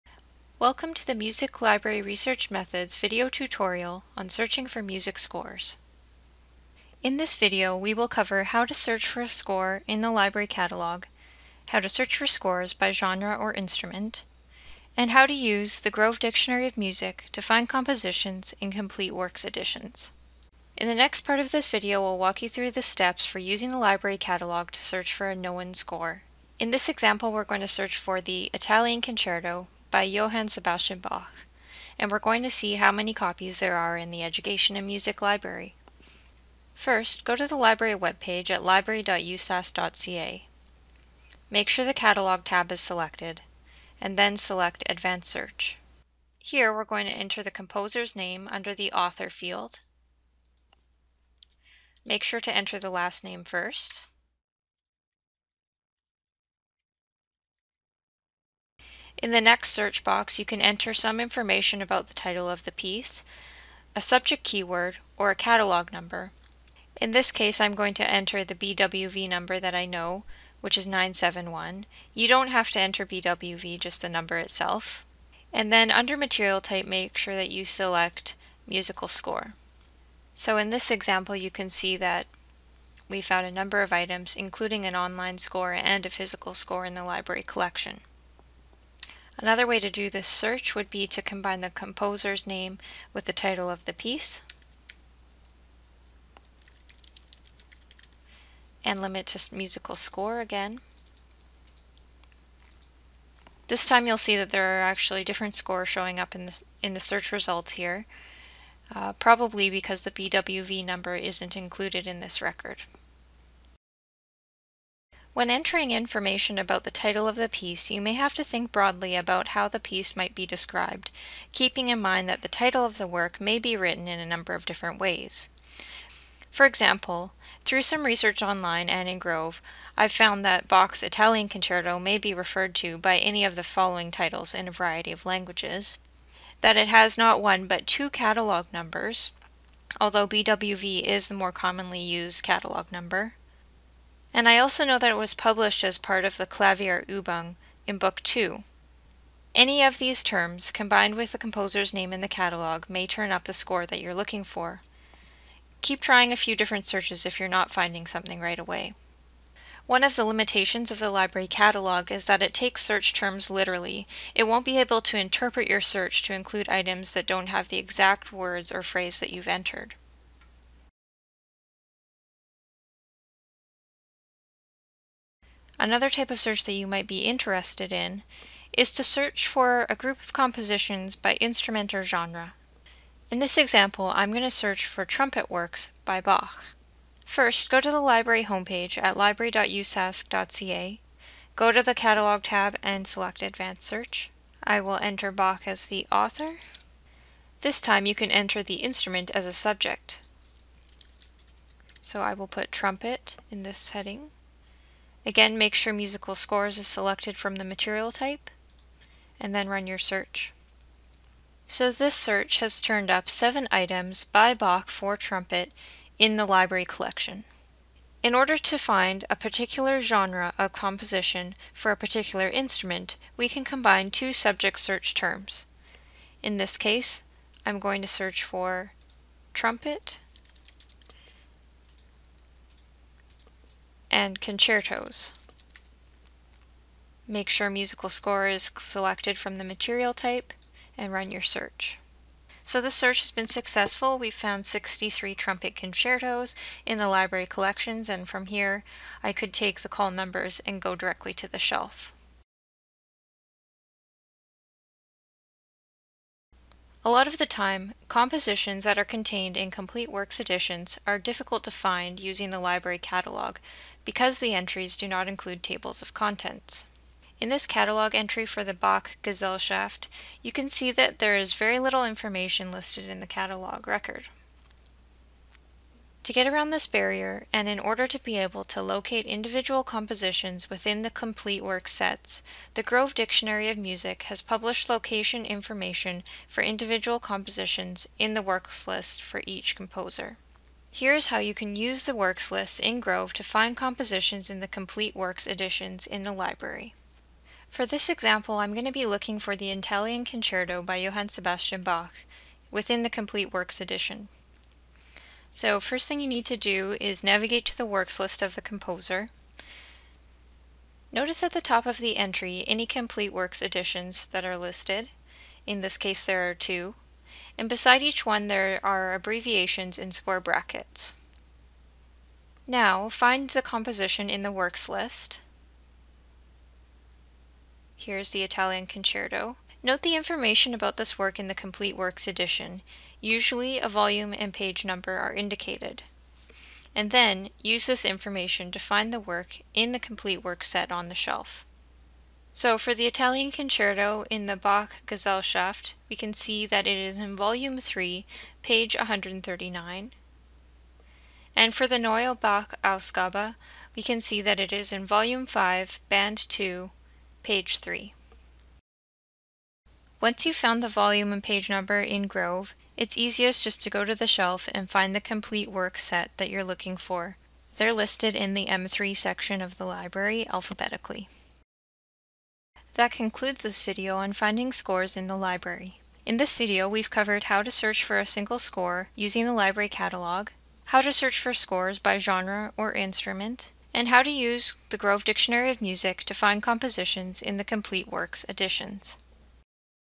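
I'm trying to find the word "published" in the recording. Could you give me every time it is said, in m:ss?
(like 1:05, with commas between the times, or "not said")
2:25, 4:44.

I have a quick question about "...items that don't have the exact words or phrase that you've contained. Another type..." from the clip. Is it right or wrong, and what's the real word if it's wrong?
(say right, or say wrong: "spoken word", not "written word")
wrong: "entered", not "contained".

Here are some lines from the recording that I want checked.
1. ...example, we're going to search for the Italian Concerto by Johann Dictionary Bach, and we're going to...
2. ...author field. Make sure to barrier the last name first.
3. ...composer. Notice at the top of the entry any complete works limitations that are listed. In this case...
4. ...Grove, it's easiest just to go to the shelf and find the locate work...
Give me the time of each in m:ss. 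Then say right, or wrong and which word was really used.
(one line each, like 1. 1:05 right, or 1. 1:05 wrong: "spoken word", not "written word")
1. 0:26 wrong: "Sebastian", not "Dictionary"
2. 0:48 wrong: "enter", not "barrier"
3. 5:08 wrong: "editions", not "limitations"
4. 6:02 wrong: "complete", not "locate".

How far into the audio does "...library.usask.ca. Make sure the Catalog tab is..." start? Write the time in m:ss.
0:38.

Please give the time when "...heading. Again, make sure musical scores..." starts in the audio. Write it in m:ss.
3:23.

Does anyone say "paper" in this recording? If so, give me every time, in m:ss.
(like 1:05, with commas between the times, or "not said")
not said.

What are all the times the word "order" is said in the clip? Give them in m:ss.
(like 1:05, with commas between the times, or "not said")
3:38, 4:37.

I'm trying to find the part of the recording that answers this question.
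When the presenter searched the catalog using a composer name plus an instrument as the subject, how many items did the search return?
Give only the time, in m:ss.
3:33.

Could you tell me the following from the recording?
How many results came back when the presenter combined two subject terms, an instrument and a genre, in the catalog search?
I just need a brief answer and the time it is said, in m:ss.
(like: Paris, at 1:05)
63, at 4:04.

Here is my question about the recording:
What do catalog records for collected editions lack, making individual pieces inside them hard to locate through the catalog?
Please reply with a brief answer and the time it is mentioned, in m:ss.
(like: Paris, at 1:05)
Tables of contents, at 4:25.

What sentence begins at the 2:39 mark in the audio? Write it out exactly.
One of the limitations of the library catalog is that it takes search terms literally.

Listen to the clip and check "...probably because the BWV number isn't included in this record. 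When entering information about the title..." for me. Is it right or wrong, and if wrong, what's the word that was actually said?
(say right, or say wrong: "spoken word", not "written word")
right.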